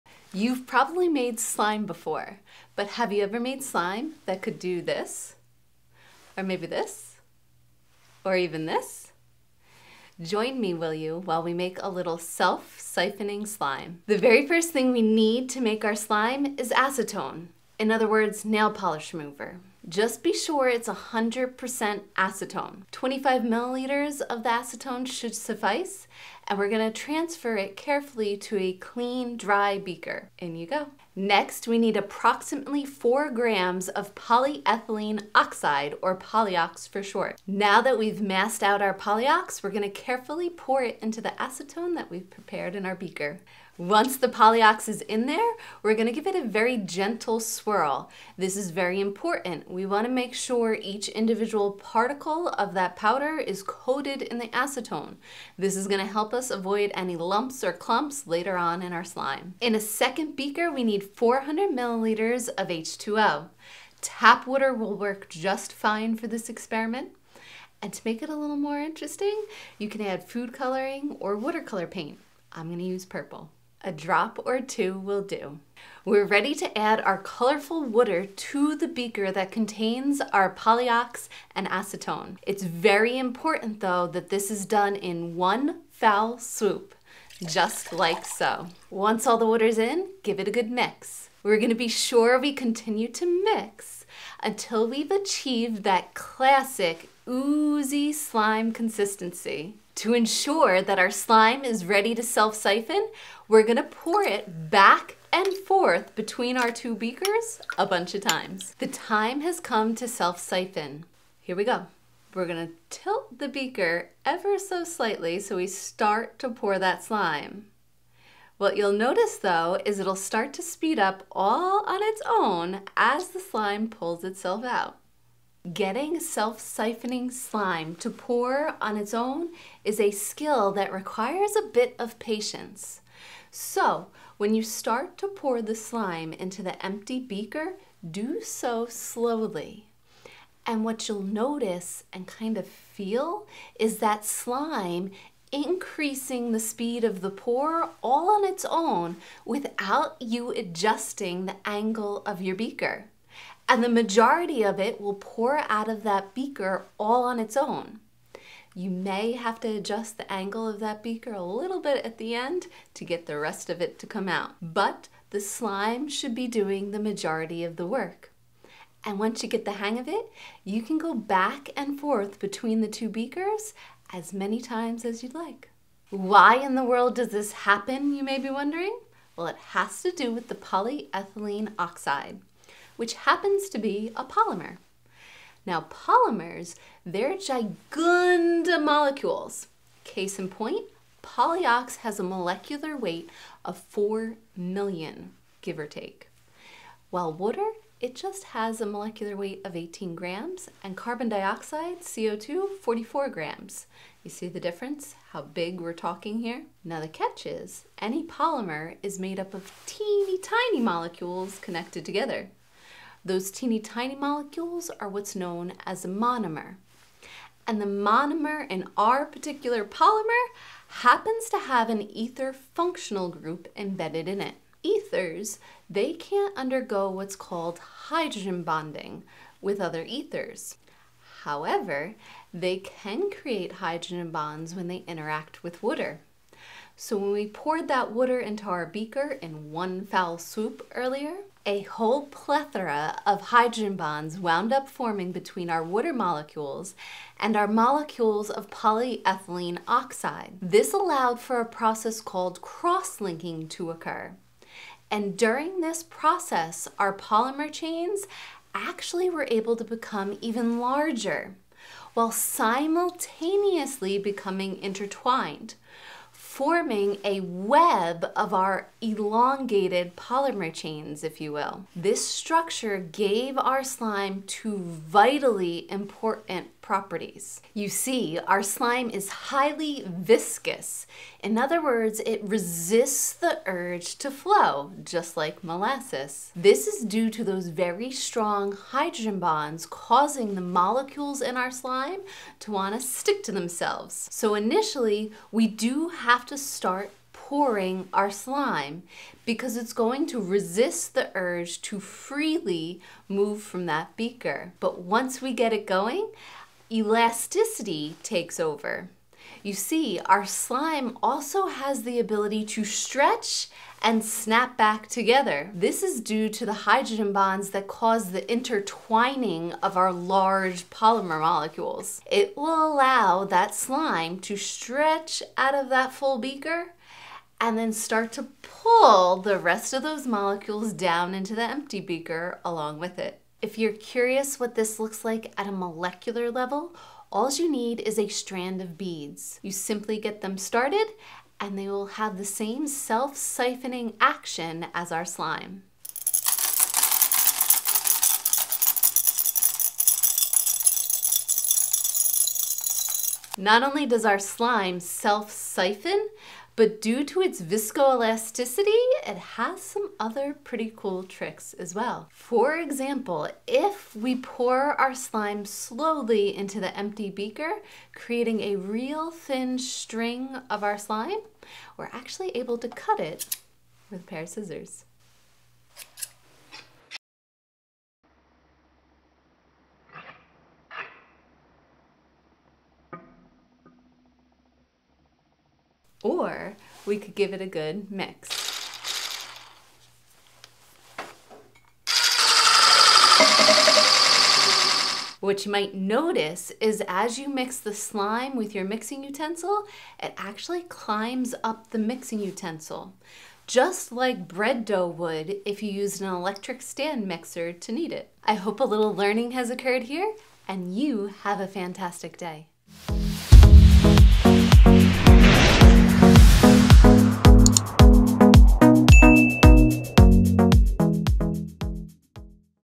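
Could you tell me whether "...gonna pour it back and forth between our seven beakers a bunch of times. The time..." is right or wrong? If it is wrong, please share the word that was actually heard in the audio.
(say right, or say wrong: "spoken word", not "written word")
wrong: "two", not "seven".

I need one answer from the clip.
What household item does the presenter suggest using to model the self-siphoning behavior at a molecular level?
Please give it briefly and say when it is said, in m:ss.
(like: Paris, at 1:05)
A strand of beads, at 5:38.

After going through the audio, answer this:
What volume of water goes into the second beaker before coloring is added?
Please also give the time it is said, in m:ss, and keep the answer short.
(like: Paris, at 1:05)
400 milliliters, at 1:01.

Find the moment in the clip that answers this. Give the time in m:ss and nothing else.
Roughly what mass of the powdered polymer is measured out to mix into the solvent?
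0:32.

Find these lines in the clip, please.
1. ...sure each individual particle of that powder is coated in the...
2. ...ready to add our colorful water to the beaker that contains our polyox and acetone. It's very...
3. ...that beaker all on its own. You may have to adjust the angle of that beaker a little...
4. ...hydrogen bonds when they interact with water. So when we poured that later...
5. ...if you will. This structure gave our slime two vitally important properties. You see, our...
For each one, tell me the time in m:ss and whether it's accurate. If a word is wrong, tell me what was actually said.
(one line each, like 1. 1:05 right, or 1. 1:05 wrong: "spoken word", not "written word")
1. 0:50 right
2. 1:16 right
3. 2:36 right
4. 3:53 wrong: "water", not "later"
5. 4:31 right.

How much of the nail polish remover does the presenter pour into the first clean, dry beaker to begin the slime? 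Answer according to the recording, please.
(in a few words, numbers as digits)
25 milliliters.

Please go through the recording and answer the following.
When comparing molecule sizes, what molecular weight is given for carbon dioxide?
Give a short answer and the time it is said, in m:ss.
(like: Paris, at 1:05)
44 grams, at 3:22.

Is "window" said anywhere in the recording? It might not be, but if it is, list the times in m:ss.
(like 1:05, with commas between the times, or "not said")
not said.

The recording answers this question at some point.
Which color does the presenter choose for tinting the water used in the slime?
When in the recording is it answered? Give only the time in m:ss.
1:13.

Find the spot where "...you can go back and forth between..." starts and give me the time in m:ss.
2:50.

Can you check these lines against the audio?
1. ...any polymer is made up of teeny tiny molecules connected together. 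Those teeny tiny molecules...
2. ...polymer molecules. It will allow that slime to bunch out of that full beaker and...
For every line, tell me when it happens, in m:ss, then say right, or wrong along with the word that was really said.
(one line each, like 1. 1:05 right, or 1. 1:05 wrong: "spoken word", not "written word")
1. 3:27 right
2. 5:20 wrong: "stretch", not "bunch".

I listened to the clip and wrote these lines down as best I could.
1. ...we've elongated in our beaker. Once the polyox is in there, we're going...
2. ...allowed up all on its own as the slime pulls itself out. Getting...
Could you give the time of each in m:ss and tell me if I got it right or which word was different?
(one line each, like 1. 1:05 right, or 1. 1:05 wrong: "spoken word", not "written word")
1. 0:42 wrong: "prepared", not "elongated"
2. 2:00 wrong: "speed", not "allowed".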